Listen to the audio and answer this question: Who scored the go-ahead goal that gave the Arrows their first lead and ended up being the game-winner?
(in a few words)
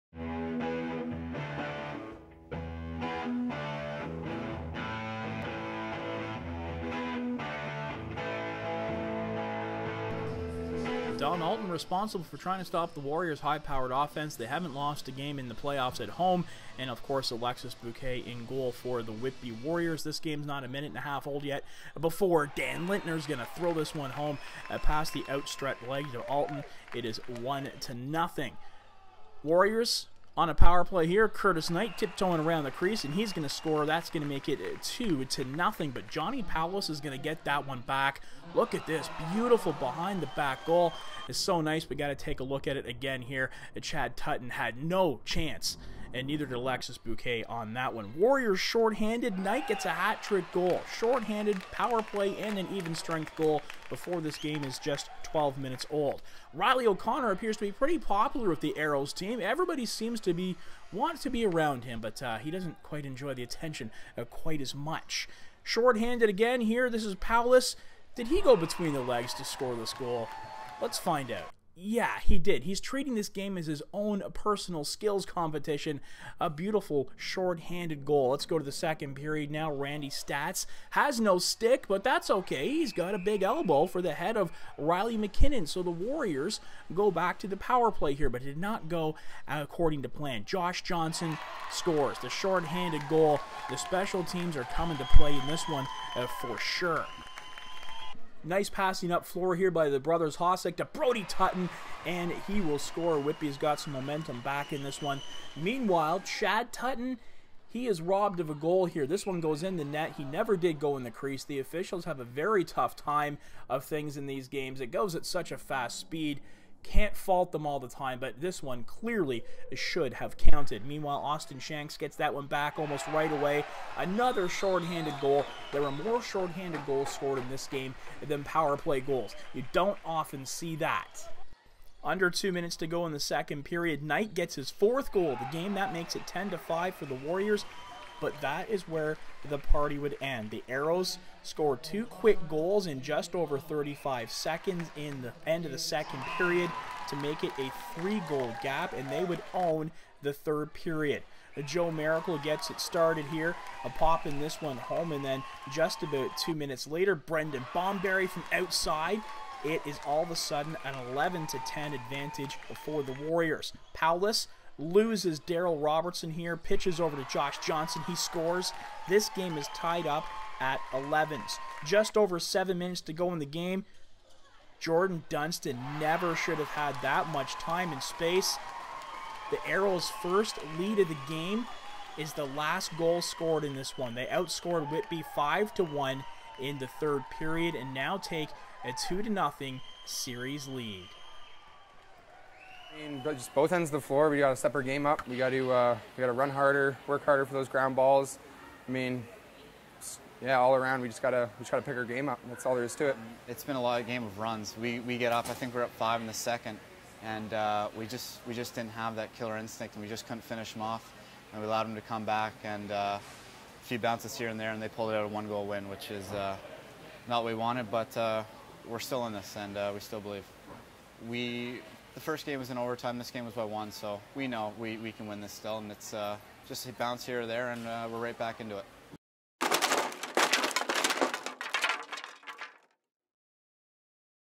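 Jordan Dunston.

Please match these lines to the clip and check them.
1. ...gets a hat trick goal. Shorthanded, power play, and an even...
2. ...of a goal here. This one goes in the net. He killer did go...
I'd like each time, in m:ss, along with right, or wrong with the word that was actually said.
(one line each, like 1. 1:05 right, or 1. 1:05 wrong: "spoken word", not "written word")
1. 0:49 right
2. 1:48 wrong: "never", not "killer".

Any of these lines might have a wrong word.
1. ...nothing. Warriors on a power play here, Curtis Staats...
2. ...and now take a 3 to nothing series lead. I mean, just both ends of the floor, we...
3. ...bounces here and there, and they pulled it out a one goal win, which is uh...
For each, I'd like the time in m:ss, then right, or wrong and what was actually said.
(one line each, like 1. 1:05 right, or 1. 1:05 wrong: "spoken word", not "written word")
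1. 0:27 wrong: "Knight", not "Staats"
2. 3:07 wrong: "2", not "3"
3. 3:33 right.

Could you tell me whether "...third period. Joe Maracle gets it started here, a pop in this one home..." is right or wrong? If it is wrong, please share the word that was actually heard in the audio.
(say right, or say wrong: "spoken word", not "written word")
right.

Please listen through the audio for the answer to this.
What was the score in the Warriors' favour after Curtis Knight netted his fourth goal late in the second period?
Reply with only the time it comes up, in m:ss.
2:16.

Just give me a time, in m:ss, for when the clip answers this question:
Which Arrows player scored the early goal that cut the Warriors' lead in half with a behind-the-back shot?
0:36.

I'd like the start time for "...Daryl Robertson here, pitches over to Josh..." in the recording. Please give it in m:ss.
2:45.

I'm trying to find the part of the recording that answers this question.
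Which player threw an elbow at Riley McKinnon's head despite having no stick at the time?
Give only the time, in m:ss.
1:19.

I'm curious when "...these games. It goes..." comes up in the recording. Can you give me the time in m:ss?
1:54.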